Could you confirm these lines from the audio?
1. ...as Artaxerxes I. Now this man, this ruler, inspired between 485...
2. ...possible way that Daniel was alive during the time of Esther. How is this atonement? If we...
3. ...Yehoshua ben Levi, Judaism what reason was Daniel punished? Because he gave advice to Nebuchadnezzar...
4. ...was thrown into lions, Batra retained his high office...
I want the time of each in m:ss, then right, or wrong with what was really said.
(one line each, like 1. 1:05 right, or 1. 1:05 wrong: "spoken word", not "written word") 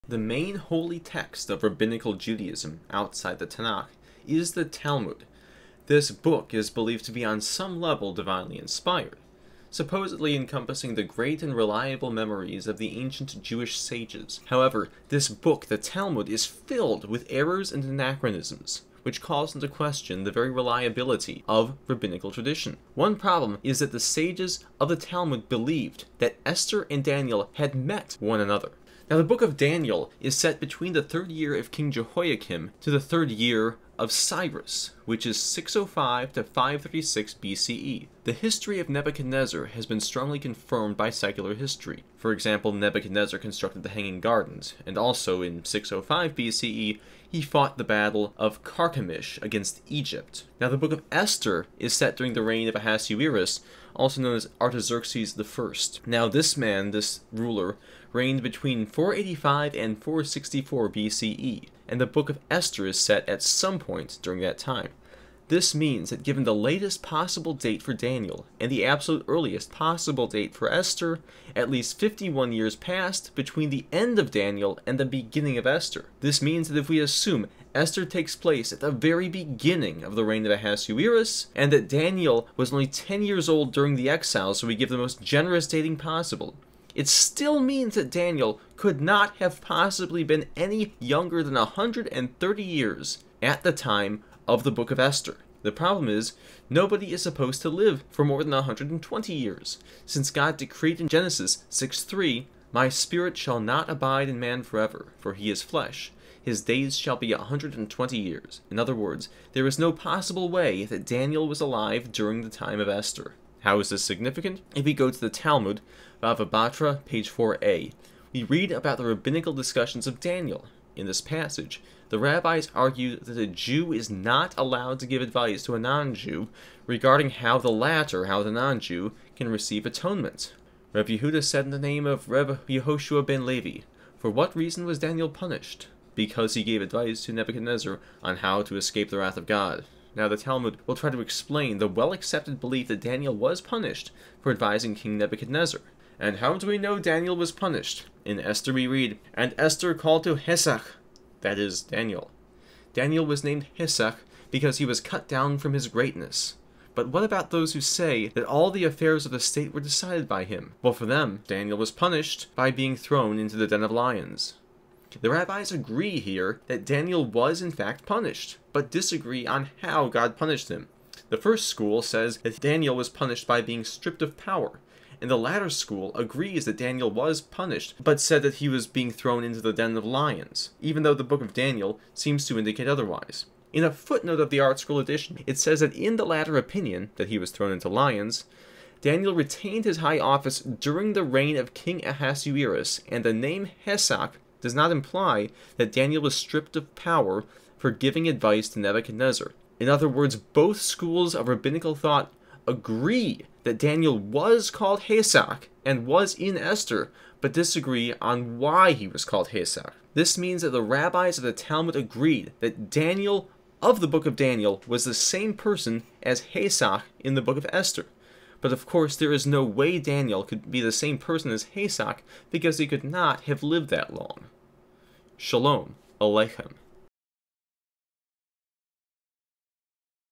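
1. 0:54 wrong: "reigned", not "inspired"
2. 1:49 wrong: "significant", not "atonement"
3. 2:12 wrong: "For", not "Judaism"
4. 3:07 wrong: "Daniel", not "Batra".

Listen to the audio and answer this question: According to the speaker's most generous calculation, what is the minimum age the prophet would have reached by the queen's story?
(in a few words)
130 years.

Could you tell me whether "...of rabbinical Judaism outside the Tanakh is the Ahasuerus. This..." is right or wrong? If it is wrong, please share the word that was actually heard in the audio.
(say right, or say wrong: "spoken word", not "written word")
wrong: "Talmud", not "Ahasuerus".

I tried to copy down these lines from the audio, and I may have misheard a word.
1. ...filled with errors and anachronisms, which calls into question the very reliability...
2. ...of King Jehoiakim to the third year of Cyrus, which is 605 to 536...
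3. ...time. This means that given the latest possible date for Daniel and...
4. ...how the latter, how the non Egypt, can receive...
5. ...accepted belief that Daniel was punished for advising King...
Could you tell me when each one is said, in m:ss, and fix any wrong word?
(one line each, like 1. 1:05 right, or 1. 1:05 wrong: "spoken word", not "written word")
1. 0:16 right
2. 0:31 right
3. 1:04 right
4. 2:07 wrong: "Jew", not "Egypt"
5. 2:22 right.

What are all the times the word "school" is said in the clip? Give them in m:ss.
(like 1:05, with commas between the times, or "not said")
2:51, 2:55, 3:20.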